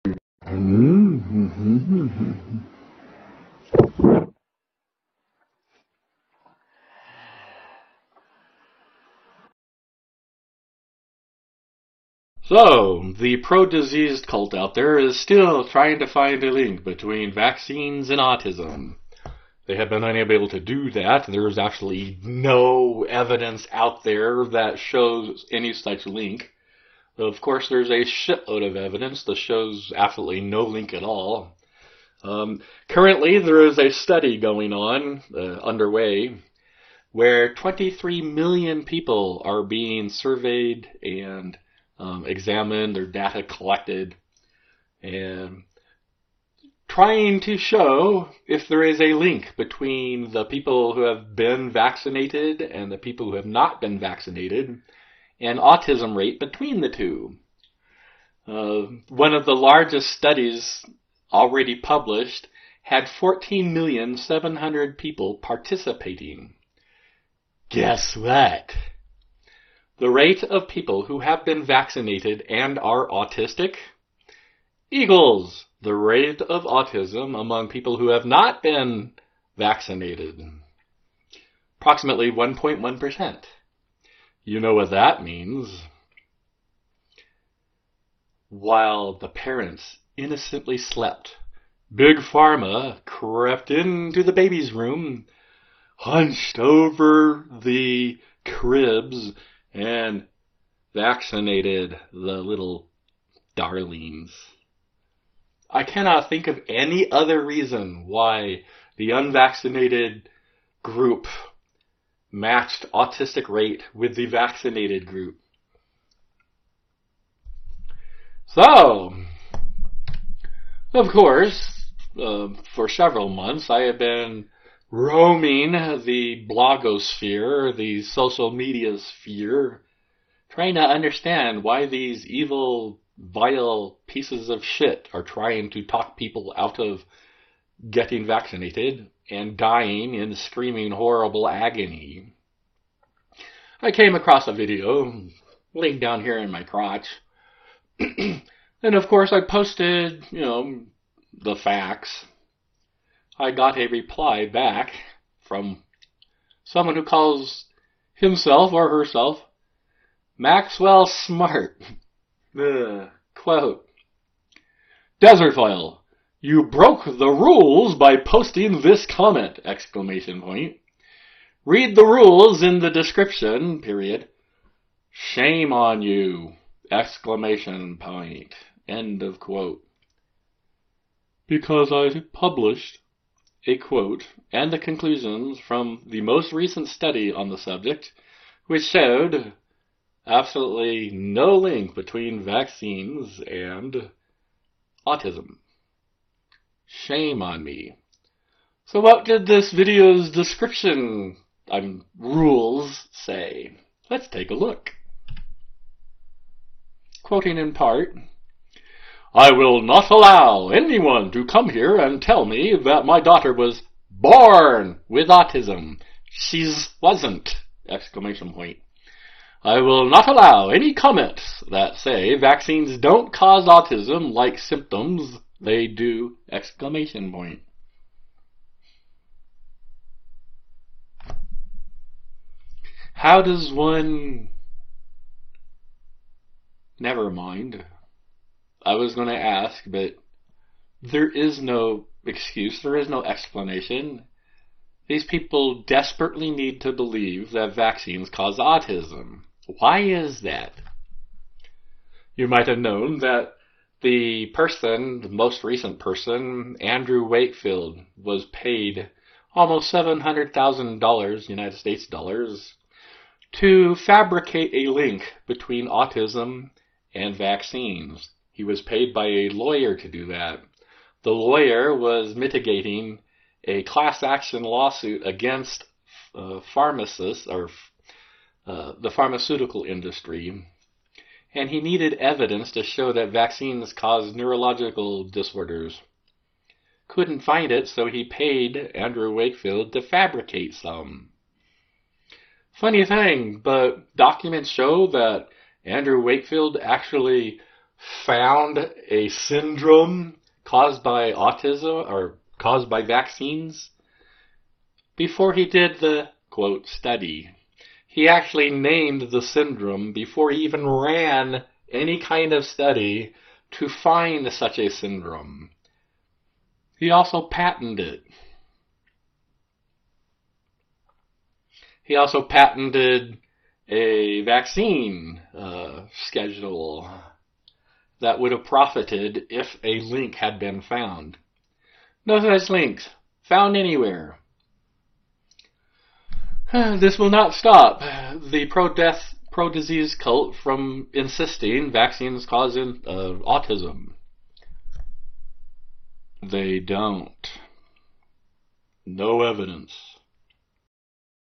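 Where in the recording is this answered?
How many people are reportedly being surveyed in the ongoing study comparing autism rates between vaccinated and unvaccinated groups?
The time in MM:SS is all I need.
00:37.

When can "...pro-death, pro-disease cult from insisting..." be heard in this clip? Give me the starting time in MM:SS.
05:38.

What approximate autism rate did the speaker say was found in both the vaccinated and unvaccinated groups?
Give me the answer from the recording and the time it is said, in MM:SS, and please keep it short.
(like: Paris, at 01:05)
1.1%, at 01:22.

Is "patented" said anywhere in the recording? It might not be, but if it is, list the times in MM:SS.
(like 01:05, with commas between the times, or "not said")
05:17, 05:22.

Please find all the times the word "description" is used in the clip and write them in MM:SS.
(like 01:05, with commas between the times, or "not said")
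02:52, 03:20.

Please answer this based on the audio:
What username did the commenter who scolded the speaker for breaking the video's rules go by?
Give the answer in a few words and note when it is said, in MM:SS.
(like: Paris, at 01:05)
Maxwell Smart, at 02:40.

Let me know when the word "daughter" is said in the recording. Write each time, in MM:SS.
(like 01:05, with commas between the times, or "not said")
03:33.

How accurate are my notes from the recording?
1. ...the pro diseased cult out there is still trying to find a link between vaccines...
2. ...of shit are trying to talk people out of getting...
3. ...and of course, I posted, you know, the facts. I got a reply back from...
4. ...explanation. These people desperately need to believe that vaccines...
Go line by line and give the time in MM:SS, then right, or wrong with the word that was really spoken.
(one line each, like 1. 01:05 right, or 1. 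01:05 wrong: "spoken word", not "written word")
1. 00:13 right
2. 02:14 right
3. 02:27 right
4. 04:03 right.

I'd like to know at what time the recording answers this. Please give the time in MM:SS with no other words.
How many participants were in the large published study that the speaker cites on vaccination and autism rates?
01:03.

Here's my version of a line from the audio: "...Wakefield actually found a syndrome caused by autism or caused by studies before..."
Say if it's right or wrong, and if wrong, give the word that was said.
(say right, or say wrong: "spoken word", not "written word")
wrong: "vaccines", not "studies".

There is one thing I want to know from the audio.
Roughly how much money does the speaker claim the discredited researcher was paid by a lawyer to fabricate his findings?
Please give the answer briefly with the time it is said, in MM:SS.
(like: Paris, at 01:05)
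$700,000, at 04:19.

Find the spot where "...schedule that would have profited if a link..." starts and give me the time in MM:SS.
05:26.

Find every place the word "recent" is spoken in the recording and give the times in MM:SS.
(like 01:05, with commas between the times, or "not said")
03:06, 04:15.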